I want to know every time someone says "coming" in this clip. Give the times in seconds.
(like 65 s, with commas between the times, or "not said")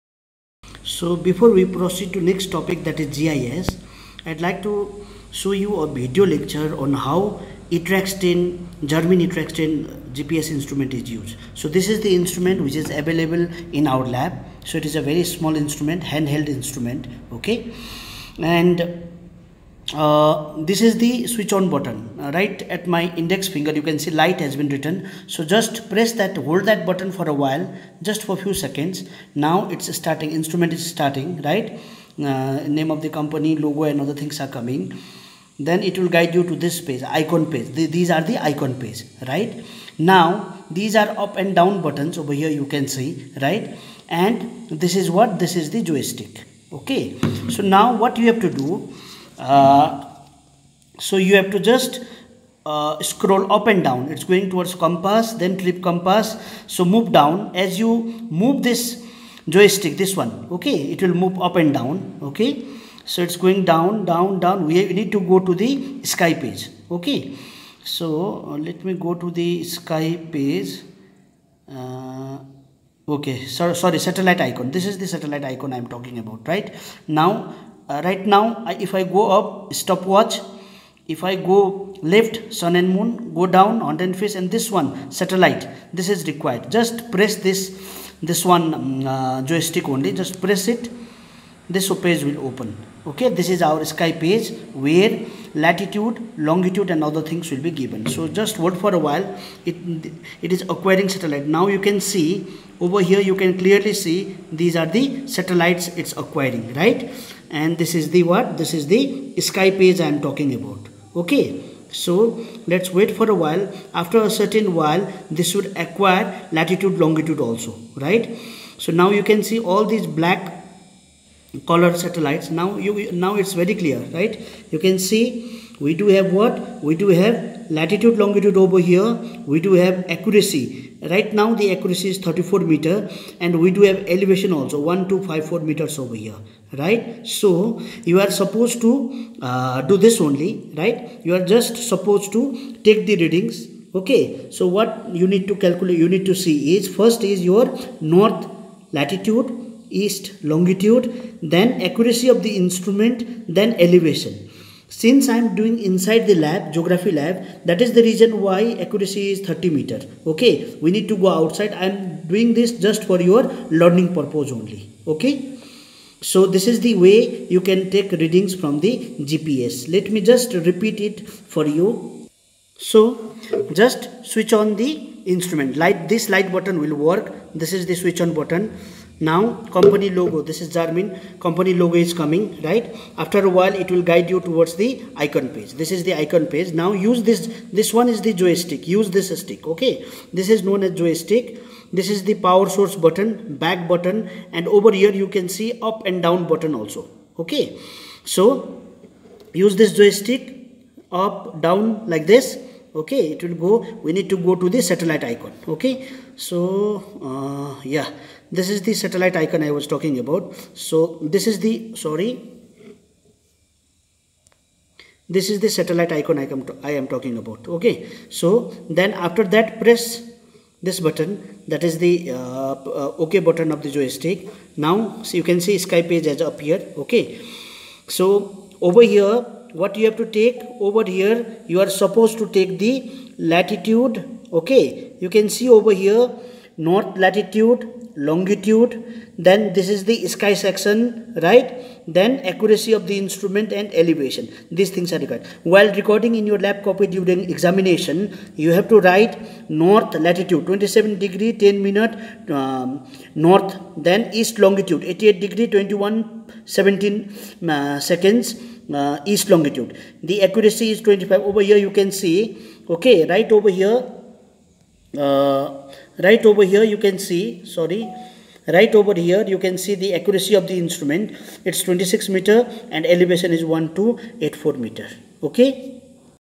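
34 s, 182 s.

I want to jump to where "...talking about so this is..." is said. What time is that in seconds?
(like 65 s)
209 s.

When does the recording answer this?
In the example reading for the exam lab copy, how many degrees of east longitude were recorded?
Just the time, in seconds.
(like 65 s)
255 s.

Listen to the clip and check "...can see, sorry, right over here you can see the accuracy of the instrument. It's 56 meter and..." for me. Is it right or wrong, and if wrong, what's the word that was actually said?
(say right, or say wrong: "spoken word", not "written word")
wrong: "26", not "56".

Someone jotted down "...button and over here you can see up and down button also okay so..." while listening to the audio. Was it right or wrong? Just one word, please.
right.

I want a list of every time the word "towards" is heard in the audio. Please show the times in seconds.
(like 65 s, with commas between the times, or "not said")
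54 s, 184 s.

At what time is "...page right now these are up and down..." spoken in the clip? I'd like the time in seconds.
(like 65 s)
38 s.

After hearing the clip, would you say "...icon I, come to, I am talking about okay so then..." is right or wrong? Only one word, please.
right.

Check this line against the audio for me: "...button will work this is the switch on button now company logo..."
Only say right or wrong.
right.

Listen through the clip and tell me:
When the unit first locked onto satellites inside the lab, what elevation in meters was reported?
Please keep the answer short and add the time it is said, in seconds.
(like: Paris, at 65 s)
1254 meters, at 134 s.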